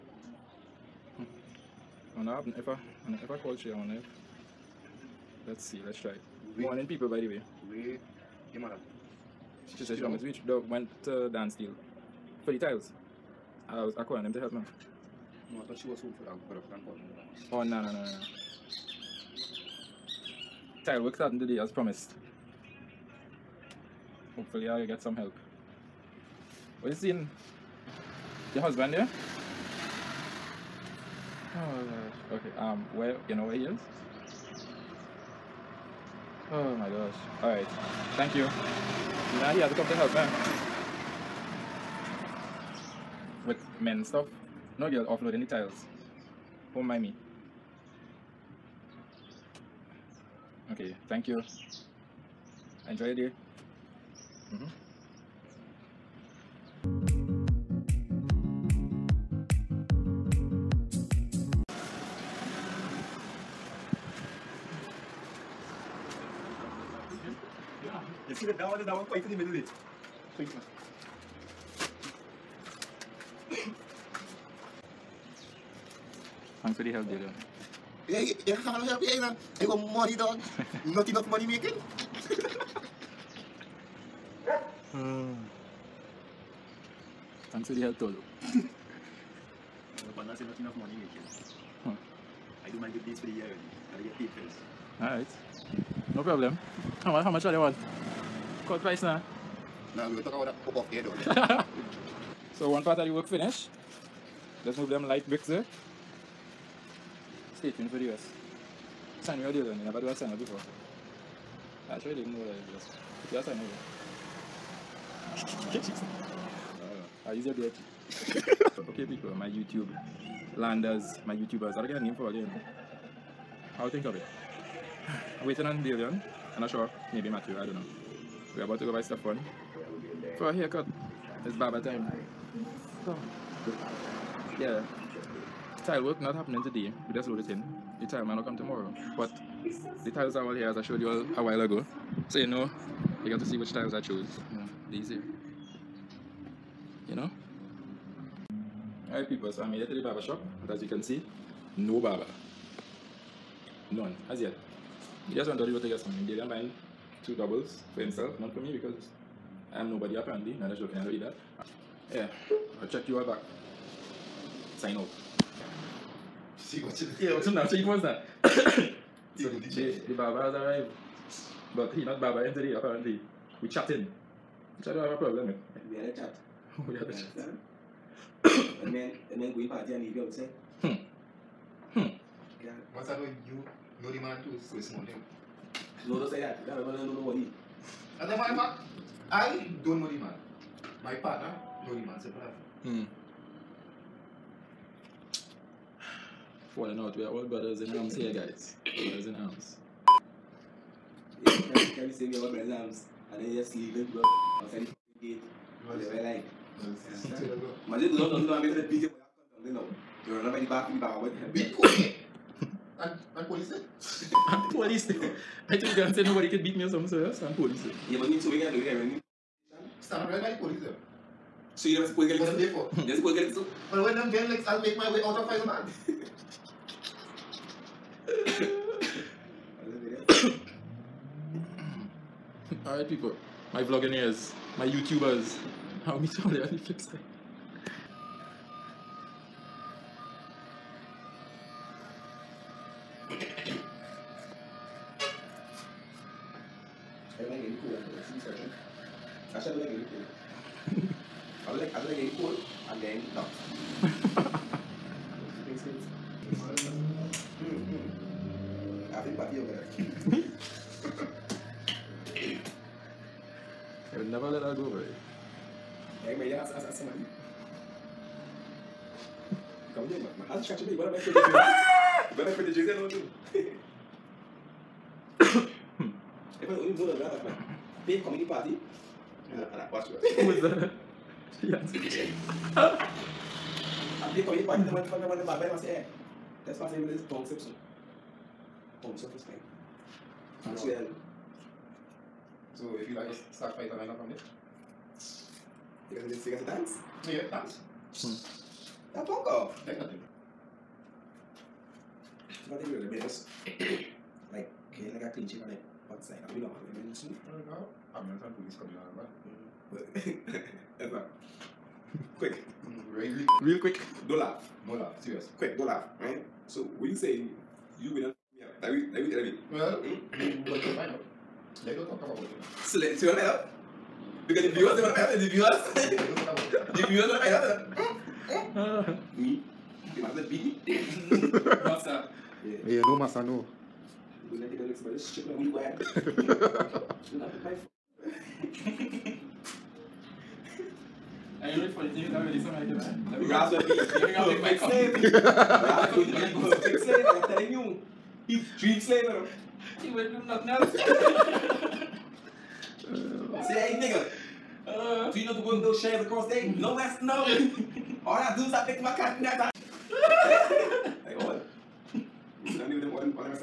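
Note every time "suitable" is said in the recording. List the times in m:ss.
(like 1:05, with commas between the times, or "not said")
not said.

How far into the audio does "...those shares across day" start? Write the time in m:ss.
5:55.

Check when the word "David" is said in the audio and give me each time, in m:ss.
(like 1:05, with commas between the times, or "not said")
5:18.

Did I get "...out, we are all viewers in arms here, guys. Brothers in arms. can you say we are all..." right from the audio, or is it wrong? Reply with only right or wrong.
wrong.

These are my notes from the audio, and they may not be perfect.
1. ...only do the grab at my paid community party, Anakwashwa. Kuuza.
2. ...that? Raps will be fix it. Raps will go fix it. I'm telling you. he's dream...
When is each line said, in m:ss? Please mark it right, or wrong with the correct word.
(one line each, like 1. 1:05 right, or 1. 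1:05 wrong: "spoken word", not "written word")
1. 4:36 right
2. 5:43 right.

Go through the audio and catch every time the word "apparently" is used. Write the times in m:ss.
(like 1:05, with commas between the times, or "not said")
2:40, 2:52.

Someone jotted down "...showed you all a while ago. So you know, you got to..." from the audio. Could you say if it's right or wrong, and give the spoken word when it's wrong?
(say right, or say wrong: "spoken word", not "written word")
right.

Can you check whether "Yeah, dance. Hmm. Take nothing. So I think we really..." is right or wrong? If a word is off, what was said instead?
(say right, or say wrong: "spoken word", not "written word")
right.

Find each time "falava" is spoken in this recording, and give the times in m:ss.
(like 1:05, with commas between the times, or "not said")
3:12.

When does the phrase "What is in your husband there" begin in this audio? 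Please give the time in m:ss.
0:26.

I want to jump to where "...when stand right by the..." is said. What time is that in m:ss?
3:38.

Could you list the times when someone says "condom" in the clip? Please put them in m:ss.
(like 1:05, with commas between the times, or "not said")
3:29.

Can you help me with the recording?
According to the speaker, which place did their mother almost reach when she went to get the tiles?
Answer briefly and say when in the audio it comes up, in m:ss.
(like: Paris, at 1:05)
Dan Steel, at 0:11.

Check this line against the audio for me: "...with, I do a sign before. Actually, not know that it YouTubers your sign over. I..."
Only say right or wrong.
wrong.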